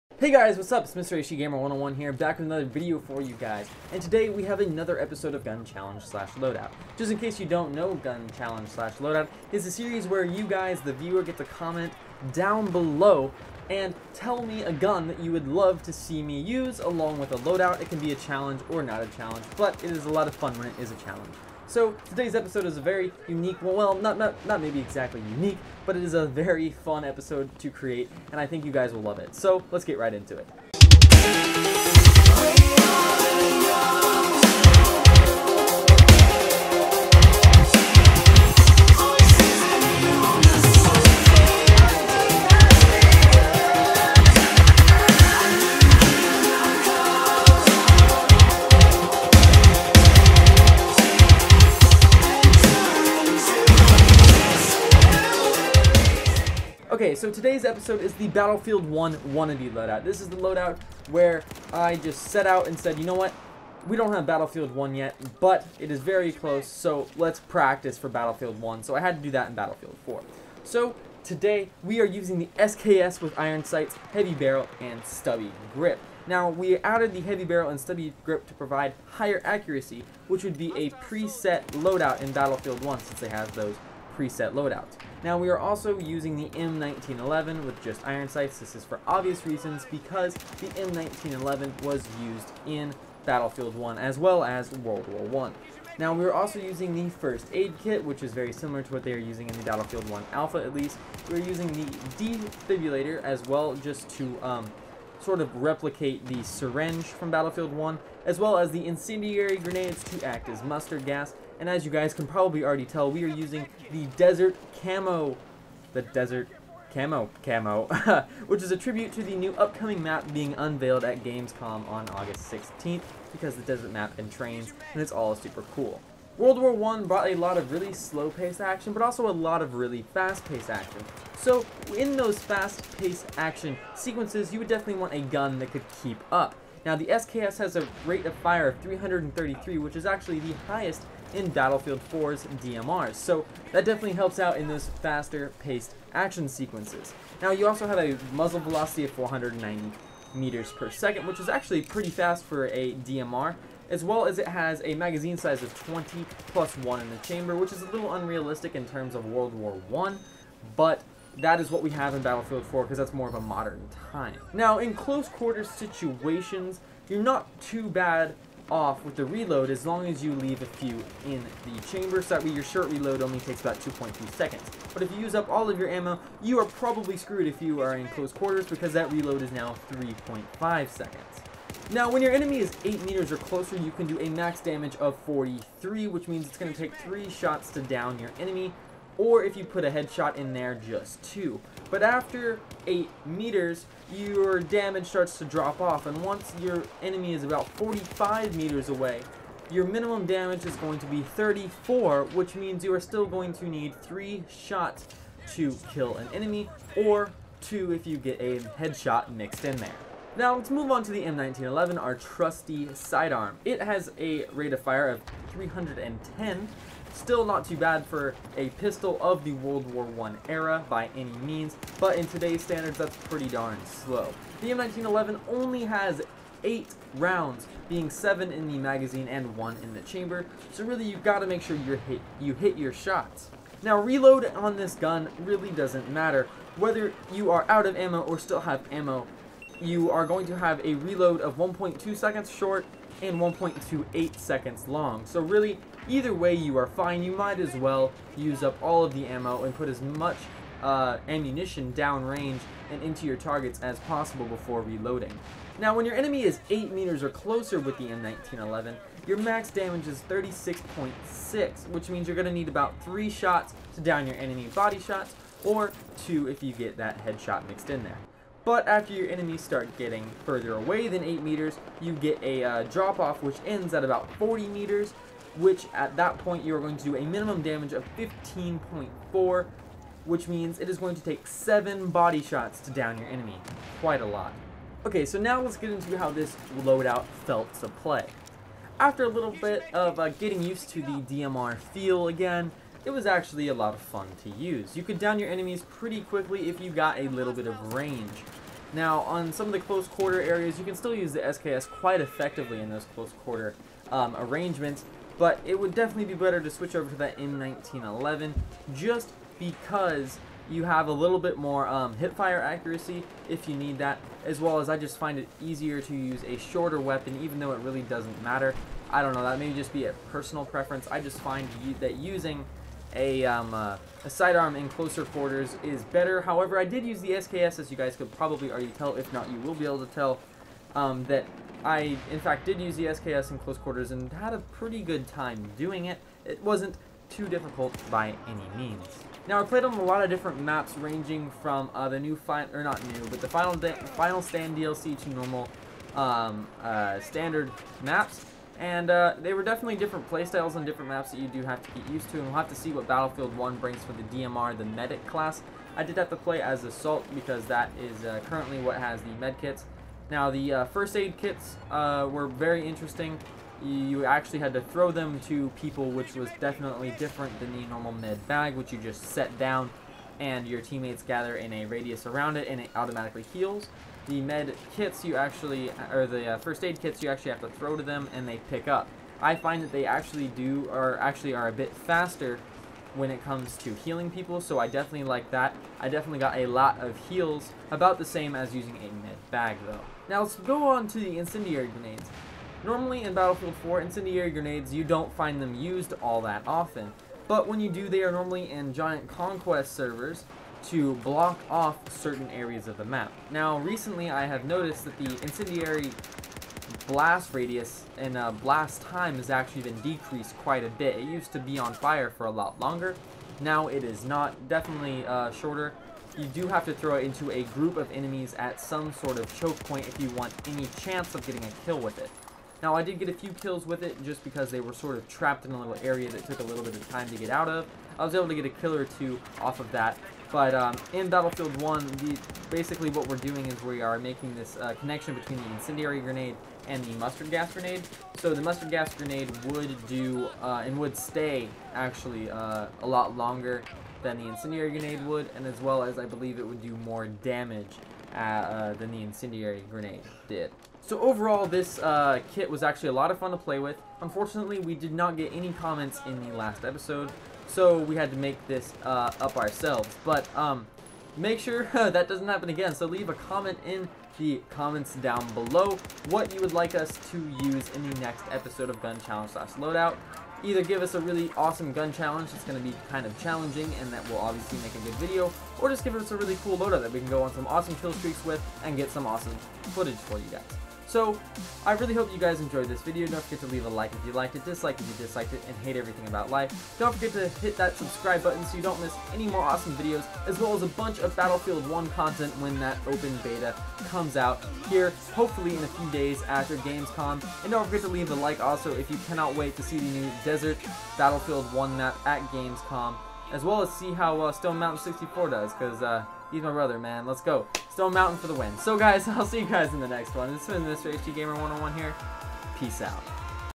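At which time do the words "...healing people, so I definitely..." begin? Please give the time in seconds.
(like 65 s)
383 s.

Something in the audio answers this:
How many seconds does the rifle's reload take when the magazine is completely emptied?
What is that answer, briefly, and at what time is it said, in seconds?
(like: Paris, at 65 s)
3.5 seconds, at 179 s.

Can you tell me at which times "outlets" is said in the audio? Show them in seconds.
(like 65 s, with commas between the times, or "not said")
not said.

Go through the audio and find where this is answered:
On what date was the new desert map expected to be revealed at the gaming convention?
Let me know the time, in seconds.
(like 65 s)
122 s.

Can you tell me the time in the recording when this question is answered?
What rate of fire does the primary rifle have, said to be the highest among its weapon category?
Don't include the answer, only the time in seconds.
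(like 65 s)
138 s.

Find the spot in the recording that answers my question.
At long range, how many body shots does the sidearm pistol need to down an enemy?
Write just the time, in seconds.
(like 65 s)
281 s.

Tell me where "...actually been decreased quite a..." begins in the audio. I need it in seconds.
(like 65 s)
409 s.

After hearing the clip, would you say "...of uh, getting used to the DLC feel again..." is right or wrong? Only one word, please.
wrong.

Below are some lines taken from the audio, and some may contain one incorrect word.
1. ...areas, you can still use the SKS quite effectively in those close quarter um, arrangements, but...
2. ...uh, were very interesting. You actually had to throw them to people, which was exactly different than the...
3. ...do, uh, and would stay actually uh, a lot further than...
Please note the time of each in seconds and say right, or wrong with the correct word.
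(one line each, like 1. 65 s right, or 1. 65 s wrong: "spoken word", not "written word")
1. 300 s right
2. 361 s wrong: "definitely", not "exactly"
3. 440 s wrong: "longer", not "further".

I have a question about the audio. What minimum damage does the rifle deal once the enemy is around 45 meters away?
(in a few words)
34.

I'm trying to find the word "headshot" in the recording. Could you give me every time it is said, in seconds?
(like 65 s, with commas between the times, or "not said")
189 s, 208 s, 267 s.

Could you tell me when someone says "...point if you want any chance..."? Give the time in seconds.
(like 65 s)
419 s.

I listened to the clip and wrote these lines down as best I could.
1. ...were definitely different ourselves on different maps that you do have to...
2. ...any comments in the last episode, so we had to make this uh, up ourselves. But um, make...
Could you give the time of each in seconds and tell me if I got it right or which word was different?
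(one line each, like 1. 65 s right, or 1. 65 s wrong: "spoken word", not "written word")
1. 349 s wrong: "playstyles", not "ourselves"
2. 455 s right.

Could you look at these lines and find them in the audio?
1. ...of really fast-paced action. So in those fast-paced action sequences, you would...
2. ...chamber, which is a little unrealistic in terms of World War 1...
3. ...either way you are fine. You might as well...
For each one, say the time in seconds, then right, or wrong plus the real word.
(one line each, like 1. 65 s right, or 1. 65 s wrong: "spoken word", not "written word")
1. 129 s right
2. 157 s right
3. 246 s right.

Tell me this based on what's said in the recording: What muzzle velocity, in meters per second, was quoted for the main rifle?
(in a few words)
490.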